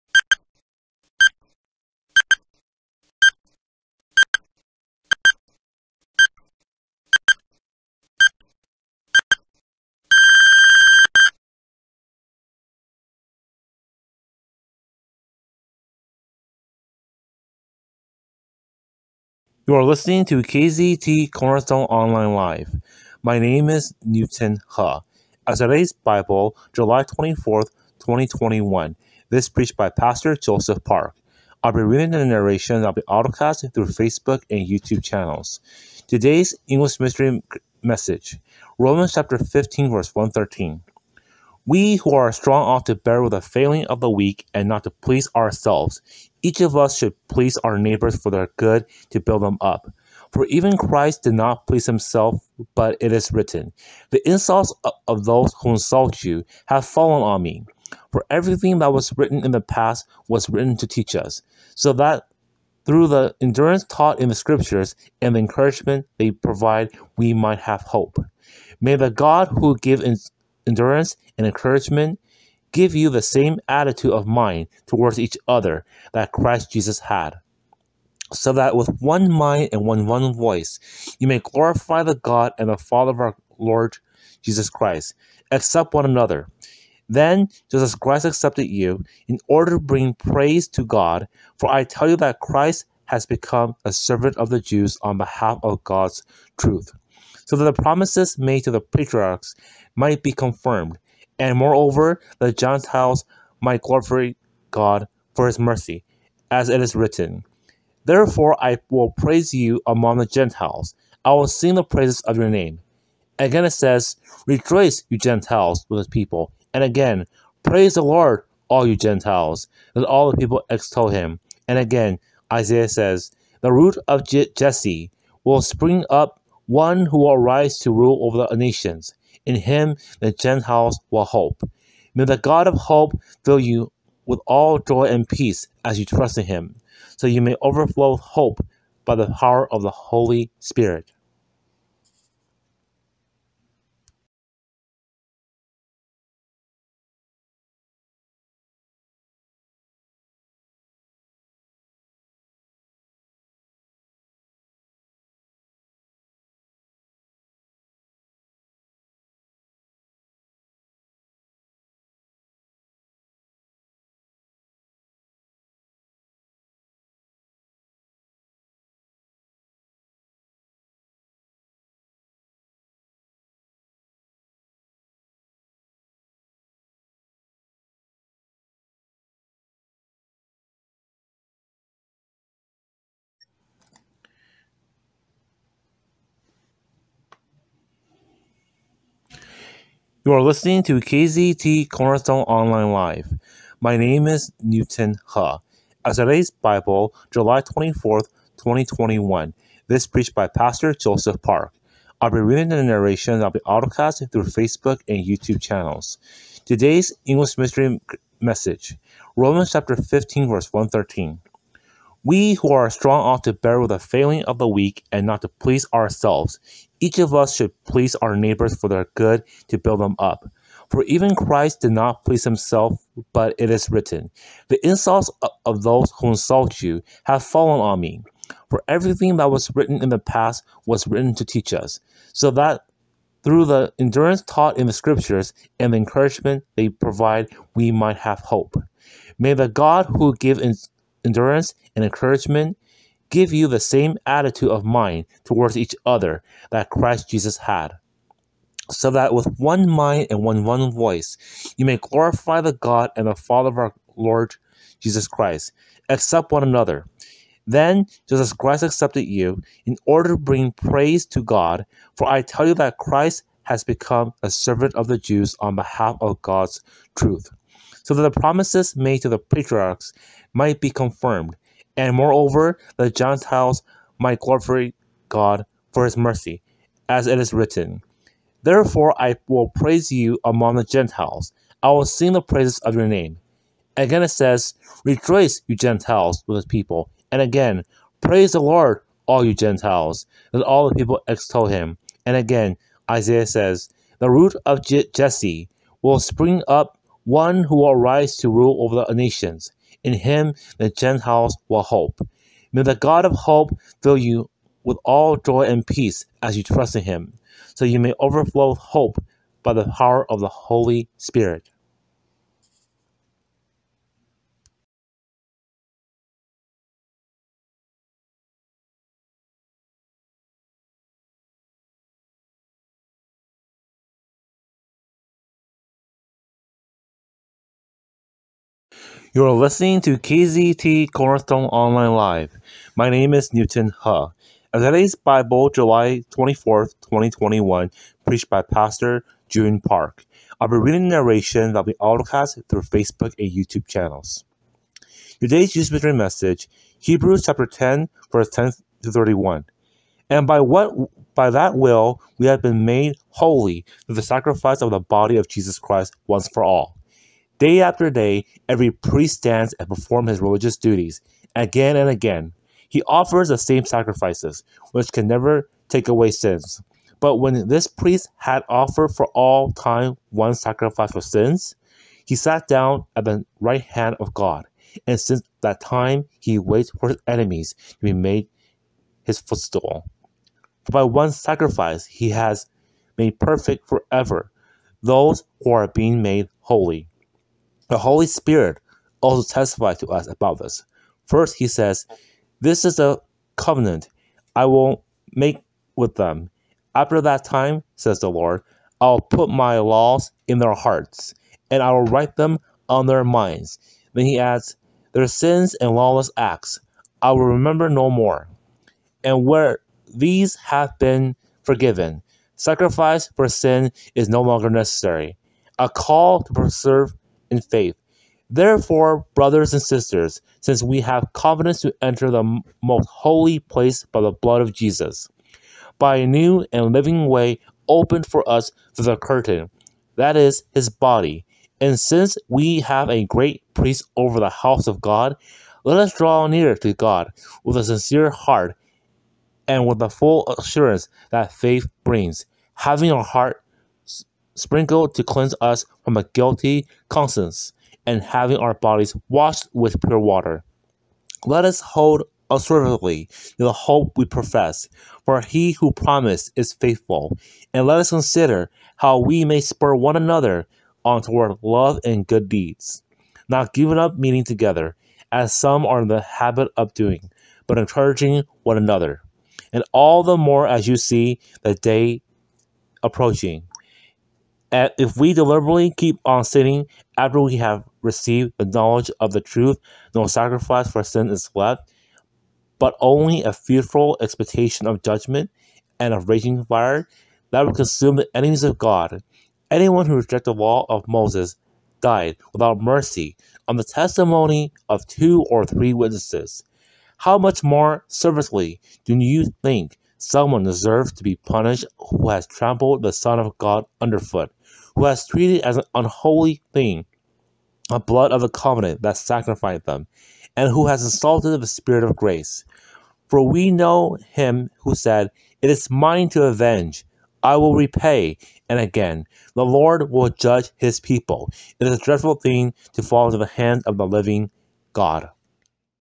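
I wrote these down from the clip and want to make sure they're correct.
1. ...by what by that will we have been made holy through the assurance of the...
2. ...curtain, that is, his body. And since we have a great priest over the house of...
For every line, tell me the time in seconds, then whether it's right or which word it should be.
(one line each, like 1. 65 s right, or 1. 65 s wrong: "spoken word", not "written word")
1. 350 s wrong: "sacrifice", not "assurance"
2. 429 s right.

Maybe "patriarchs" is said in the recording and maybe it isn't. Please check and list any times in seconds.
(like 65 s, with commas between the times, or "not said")
98 s, 269 s.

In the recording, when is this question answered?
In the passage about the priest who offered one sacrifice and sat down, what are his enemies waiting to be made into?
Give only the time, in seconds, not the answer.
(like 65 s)
379 s.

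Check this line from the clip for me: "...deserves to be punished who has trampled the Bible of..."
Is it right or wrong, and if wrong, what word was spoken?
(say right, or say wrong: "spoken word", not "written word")
wrong: "Son", not "Bible".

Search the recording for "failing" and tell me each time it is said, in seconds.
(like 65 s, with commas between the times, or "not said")
43 s, 213 s.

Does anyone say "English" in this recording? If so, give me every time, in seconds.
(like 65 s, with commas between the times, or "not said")
36 s, 207 s.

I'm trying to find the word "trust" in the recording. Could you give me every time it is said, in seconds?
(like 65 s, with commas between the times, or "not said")
136 s, 306 s.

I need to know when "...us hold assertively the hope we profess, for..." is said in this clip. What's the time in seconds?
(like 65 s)
451 s.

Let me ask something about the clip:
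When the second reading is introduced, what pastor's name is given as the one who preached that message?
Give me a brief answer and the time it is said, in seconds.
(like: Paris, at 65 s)
June Park, at 339 s.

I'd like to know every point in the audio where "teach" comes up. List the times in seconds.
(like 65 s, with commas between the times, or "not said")
60 s, 231 s.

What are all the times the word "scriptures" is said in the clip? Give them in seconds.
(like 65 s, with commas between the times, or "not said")
64 s, 234 s.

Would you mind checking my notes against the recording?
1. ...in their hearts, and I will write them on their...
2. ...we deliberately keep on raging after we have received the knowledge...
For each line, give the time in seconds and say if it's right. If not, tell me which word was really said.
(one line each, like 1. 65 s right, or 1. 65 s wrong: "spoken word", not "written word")
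1. 400 s right
2. 475 s wrong: "sinning", not "raging".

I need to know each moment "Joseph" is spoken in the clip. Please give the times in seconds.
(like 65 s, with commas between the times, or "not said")
30 s, 200 s.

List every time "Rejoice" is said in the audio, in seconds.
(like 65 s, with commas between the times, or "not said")
114 s, 285 s.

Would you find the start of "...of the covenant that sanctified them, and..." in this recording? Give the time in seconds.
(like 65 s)
508 s.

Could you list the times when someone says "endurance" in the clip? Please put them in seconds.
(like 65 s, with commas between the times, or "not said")
63 s, 70 s, 233 s, 241 s.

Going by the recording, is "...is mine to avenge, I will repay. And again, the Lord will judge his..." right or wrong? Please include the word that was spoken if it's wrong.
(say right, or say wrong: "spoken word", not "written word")
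right.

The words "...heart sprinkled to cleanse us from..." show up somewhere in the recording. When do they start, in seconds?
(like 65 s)
443 s.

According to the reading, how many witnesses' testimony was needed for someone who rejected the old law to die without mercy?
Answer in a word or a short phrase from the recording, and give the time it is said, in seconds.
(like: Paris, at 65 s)
2 or 3, at 495 s.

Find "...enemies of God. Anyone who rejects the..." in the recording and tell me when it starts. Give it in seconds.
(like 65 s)
488 s.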